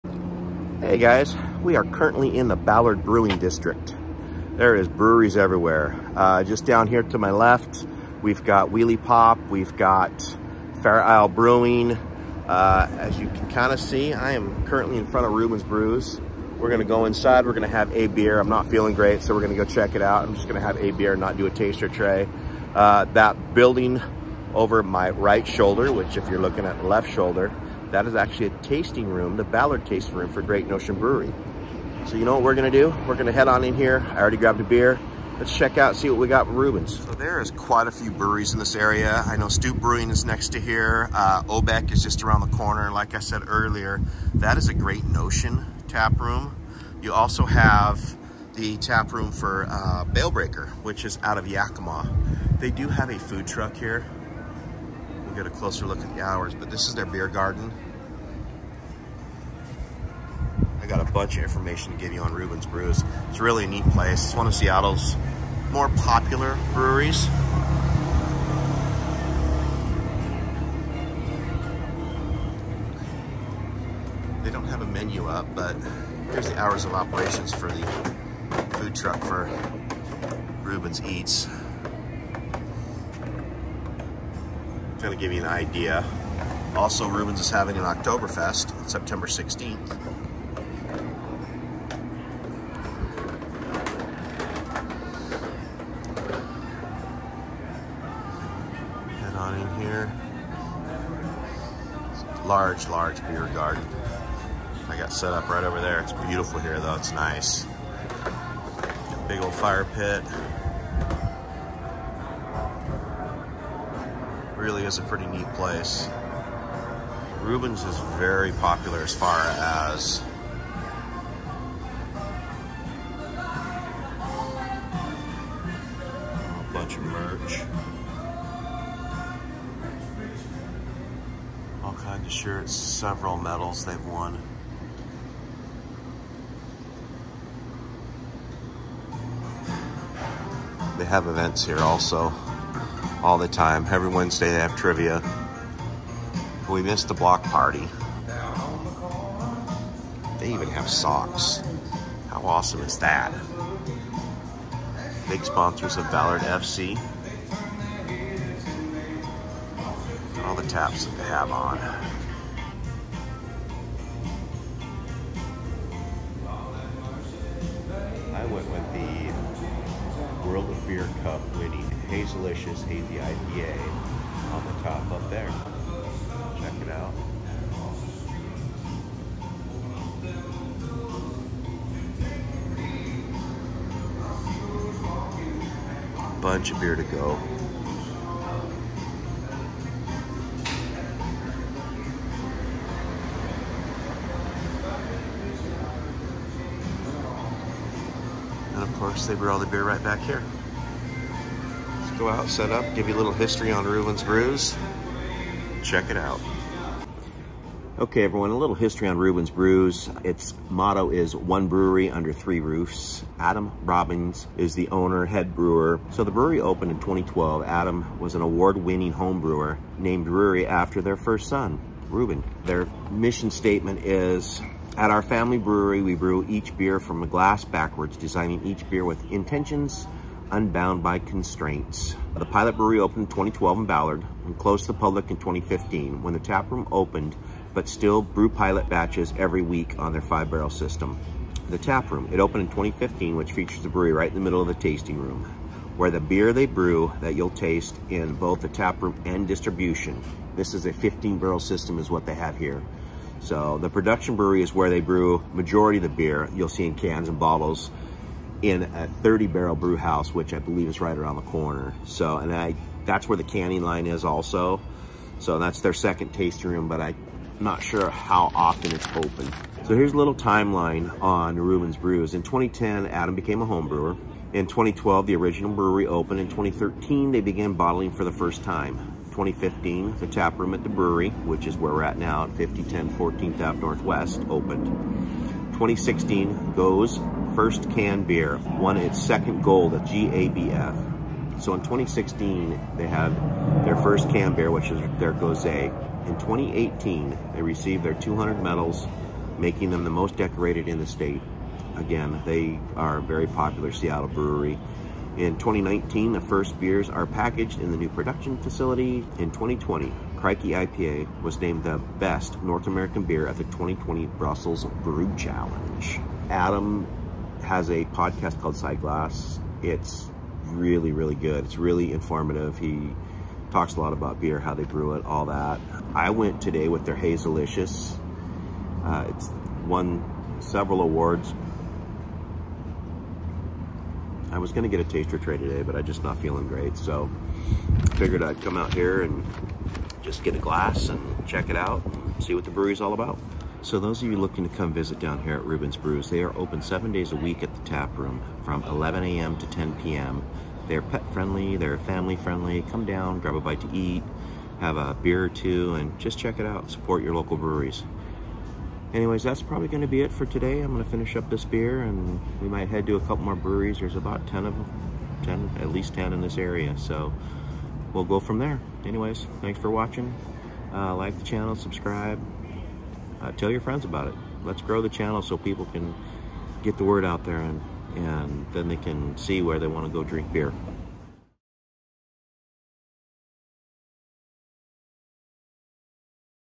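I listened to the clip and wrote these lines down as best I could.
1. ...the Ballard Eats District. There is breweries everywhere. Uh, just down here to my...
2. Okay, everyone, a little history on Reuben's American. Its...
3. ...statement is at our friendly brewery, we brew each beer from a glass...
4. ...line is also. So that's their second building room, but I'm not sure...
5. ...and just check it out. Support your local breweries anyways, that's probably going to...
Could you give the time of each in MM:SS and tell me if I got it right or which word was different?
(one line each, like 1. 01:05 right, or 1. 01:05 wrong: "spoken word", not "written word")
1. 00:02 wrong: "Brewing", not "Eats"
2. 03:27 wrong: "Brews", not "American"
3. 03:43 wrong: "family", not "friendly"
4. 04:23 wrong: "tasting", not "building"
5. 05:55 right.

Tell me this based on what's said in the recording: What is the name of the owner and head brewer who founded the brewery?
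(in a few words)
Adam Robbins.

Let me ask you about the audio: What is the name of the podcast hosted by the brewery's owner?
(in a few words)
Side Glass.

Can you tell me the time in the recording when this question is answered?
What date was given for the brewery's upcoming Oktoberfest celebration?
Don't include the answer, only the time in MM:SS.
01:28.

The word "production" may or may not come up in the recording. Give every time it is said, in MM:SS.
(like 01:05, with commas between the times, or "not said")
04:13, 05:08.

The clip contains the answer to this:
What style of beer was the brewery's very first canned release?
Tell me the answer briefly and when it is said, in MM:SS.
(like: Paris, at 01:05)
Gose, at 04:55.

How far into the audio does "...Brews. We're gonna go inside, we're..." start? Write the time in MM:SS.
00:15.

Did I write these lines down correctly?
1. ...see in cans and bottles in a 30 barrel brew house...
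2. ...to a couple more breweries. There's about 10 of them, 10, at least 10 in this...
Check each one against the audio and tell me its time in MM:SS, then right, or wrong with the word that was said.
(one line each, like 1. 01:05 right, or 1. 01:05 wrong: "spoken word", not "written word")
1. 04:16 right
2. 06:03 right.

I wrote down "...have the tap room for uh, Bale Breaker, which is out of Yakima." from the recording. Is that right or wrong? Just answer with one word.
right.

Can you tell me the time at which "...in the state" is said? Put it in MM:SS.
05:00.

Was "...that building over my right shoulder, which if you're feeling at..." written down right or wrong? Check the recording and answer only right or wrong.
wrong.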